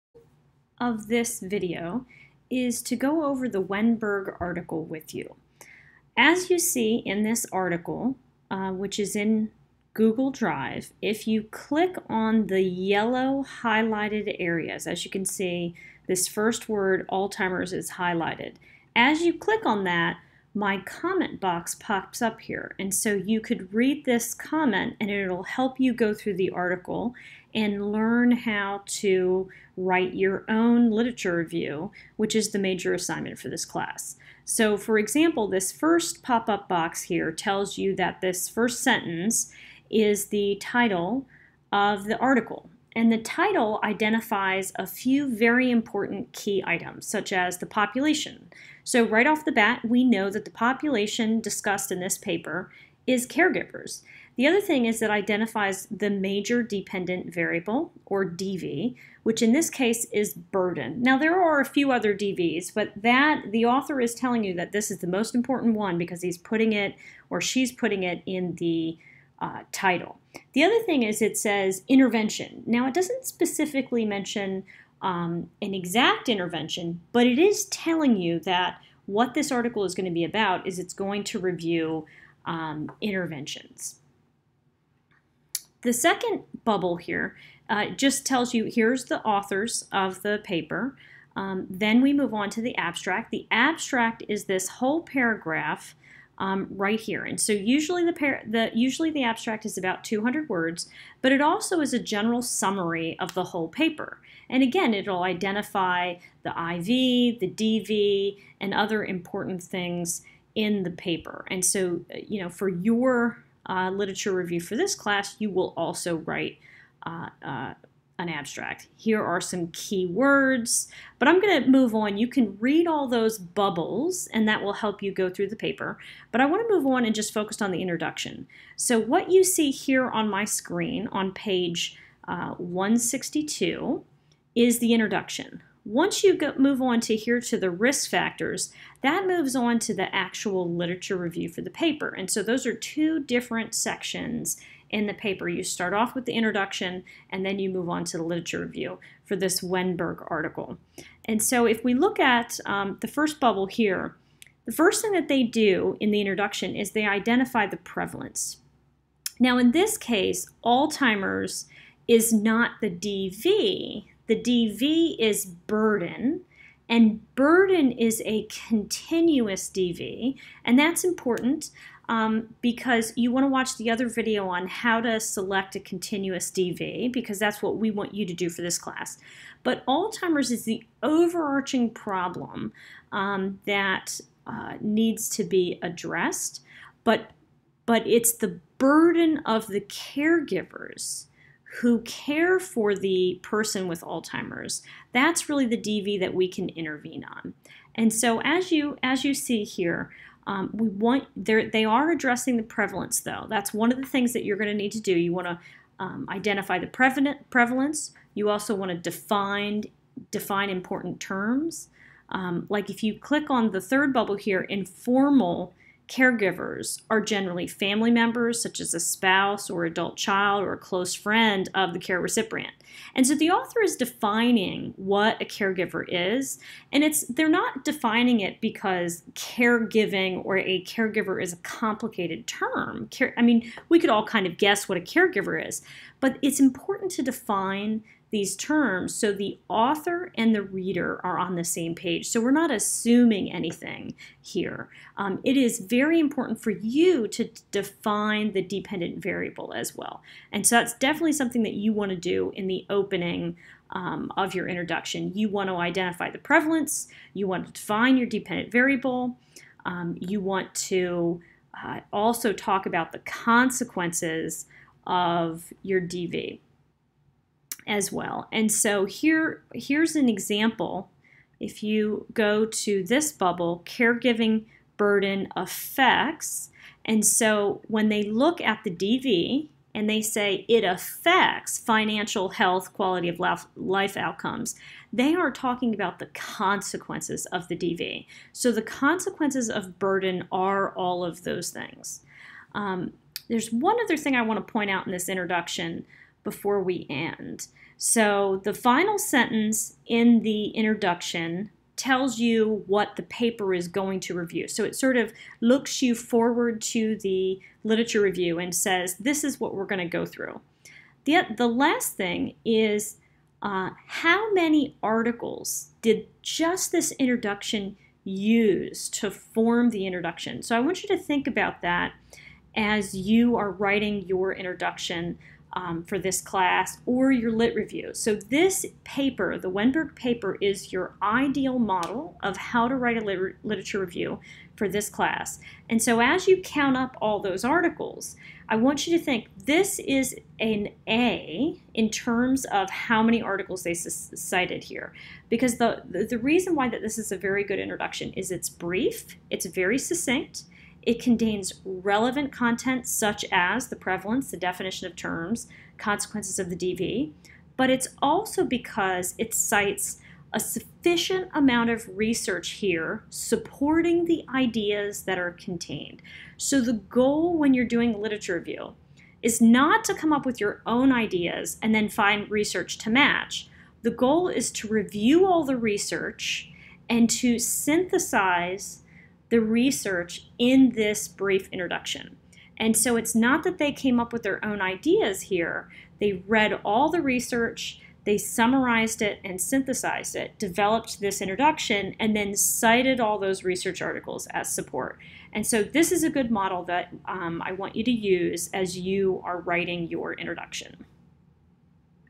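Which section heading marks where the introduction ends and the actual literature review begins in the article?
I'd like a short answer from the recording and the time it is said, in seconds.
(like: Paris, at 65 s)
risk factors, at 137 s.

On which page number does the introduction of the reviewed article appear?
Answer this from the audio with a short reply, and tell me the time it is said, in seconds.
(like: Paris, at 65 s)
162, at 132 s.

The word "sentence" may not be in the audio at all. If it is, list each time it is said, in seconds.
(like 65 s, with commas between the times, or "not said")
38 s, 299 s.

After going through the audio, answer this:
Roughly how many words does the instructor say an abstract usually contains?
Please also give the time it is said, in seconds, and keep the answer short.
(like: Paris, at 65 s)
200, at 100 s.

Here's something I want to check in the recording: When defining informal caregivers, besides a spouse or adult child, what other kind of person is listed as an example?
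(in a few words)
a close friend.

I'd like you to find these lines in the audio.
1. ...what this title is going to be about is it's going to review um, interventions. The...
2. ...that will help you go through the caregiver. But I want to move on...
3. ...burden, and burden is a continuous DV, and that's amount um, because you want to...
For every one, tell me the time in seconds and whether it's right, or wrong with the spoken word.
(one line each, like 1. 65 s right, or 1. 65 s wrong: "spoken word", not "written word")
1. 79 s wrong: "article", not "title"
2. 124 s wrong: "paper", not "caregiver"
3. 165 s wrong: "important", not "amount".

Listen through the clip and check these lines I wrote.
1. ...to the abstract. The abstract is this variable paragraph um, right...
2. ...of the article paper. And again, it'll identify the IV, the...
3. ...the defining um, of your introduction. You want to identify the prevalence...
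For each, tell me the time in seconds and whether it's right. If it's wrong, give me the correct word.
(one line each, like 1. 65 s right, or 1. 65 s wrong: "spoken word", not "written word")
1. 92 s wrong: "whole", not "variable"
2. 103 s wrong: "whole", not "article"
3. 252 s wrong: "opening", not "defining".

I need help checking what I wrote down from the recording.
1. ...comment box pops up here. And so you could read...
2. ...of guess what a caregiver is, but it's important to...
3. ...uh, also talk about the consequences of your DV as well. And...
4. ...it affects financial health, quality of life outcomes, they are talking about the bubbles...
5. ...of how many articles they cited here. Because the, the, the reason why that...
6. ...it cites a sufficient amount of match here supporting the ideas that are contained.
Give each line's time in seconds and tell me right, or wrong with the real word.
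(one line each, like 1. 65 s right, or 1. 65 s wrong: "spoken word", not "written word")
1. 20 s right
2. 234 s right
3. 261 s right
4. 280 s wrong: "consequences", not "bubbles"
5. 342 s right
6. 359 s wrong: "research", not "match".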